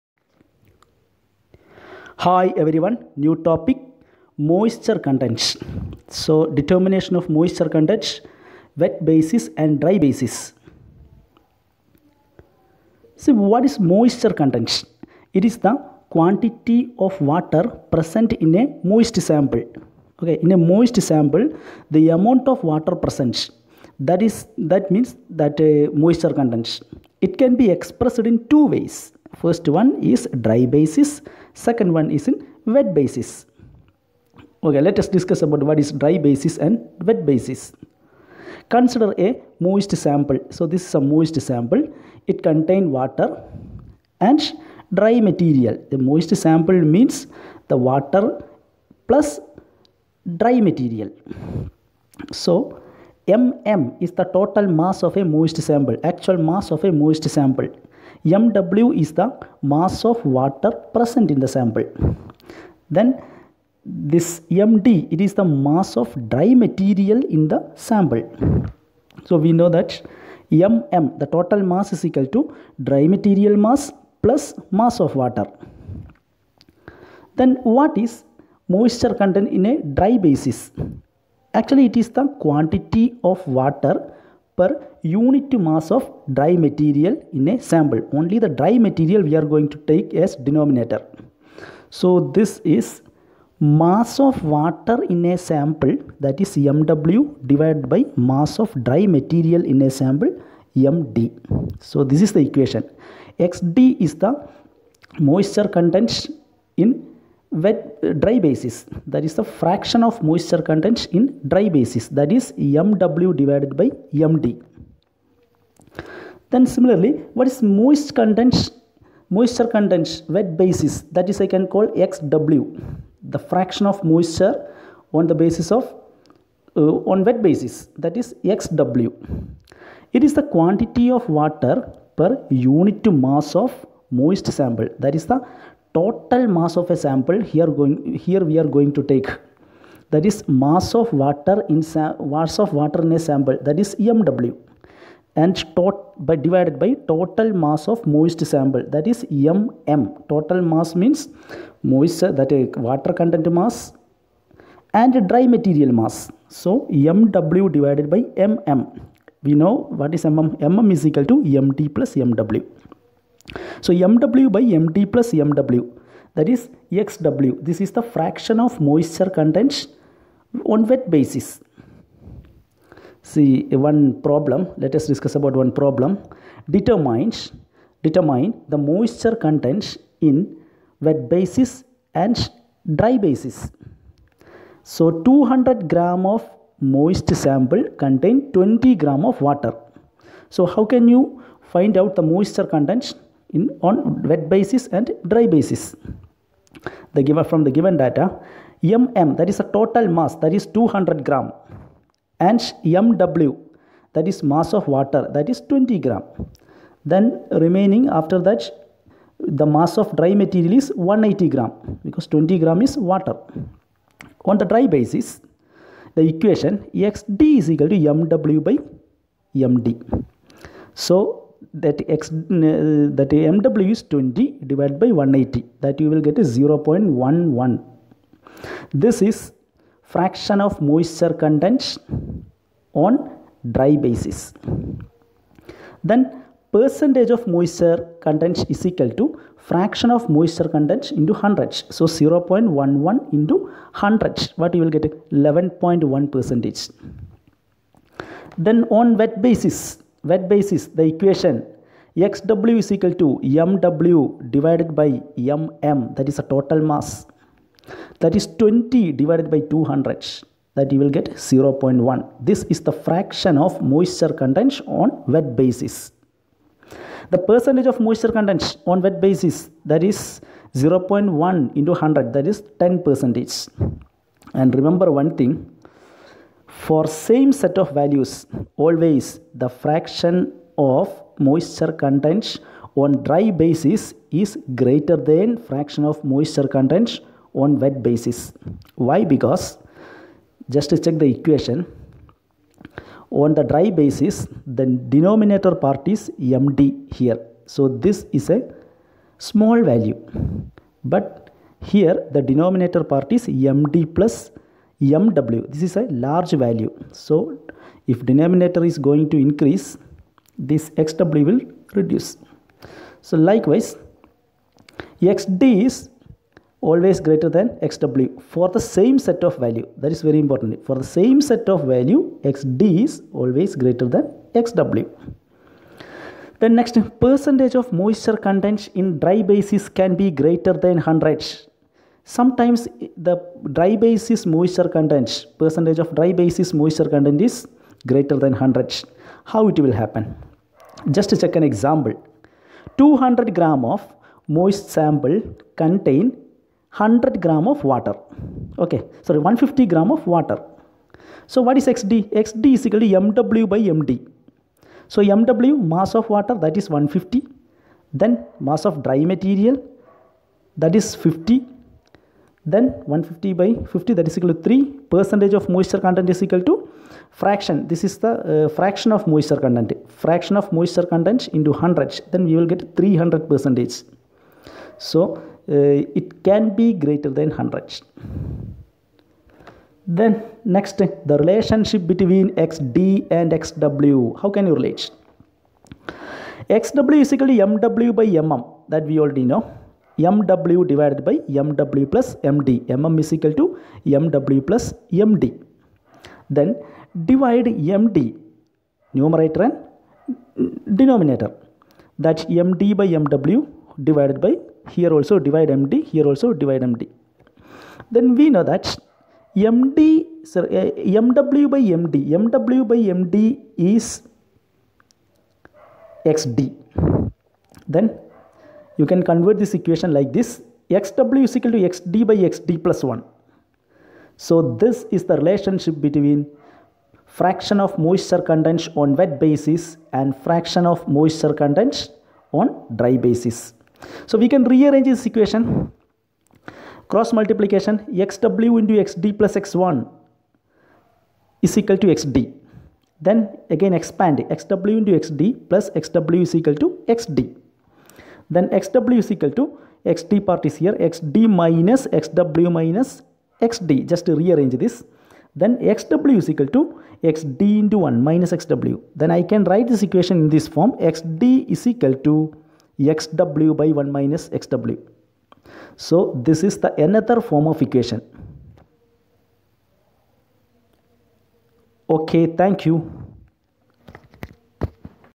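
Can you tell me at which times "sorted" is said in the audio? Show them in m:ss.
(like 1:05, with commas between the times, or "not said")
not said.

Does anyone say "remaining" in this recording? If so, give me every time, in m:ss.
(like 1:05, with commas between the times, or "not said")
3:27.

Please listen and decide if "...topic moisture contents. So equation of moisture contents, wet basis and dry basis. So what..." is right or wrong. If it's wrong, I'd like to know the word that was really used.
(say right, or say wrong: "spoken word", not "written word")
wrong: "determination", not "equation".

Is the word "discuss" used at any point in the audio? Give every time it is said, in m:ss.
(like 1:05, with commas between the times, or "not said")
0:35, 2:55.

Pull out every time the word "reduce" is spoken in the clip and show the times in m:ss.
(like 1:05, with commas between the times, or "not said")
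5:11.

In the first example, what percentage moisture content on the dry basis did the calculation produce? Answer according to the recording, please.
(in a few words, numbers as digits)
11.1 percent.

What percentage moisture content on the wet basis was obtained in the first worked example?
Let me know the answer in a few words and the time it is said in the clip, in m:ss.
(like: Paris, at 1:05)
10 percent, at 4:32.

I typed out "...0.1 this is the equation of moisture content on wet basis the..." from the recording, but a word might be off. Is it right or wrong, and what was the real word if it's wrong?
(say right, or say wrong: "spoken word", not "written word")
wrong: "fraction", not "equation".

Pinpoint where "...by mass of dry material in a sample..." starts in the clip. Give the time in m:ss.
1:37.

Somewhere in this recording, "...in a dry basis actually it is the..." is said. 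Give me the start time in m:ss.
1:19.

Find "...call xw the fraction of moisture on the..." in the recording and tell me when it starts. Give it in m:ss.
2:01.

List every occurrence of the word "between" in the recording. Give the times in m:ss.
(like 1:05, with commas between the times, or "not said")
6:22, 7:06.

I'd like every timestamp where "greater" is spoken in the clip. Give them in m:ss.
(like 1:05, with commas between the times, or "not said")
4:44, 5:17, 5:23, 5:30, 5:38, 6:16.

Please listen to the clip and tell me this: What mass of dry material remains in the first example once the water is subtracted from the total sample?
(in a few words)
180 grams.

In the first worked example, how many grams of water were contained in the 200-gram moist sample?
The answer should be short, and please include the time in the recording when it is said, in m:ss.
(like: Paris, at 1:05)
20 grams, at 3:08.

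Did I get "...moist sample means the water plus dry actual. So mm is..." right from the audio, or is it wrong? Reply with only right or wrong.
wrong.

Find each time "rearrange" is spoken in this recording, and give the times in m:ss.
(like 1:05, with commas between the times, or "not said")
7:14, 7:34.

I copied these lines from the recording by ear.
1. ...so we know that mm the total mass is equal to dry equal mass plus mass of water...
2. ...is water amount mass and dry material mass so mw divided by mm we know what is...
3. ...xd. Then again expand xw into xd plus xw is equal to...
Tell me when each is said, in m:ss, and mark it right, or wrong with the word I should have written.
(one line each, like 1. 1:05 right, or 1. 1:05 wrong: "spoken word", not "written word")
1. 1:09 wrong: "material", not "equal"
2. 2:32 wrong: "content", not "amount"
3. 7:22 right.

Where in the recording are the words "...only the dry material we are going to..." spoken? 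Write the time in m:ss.
1:28.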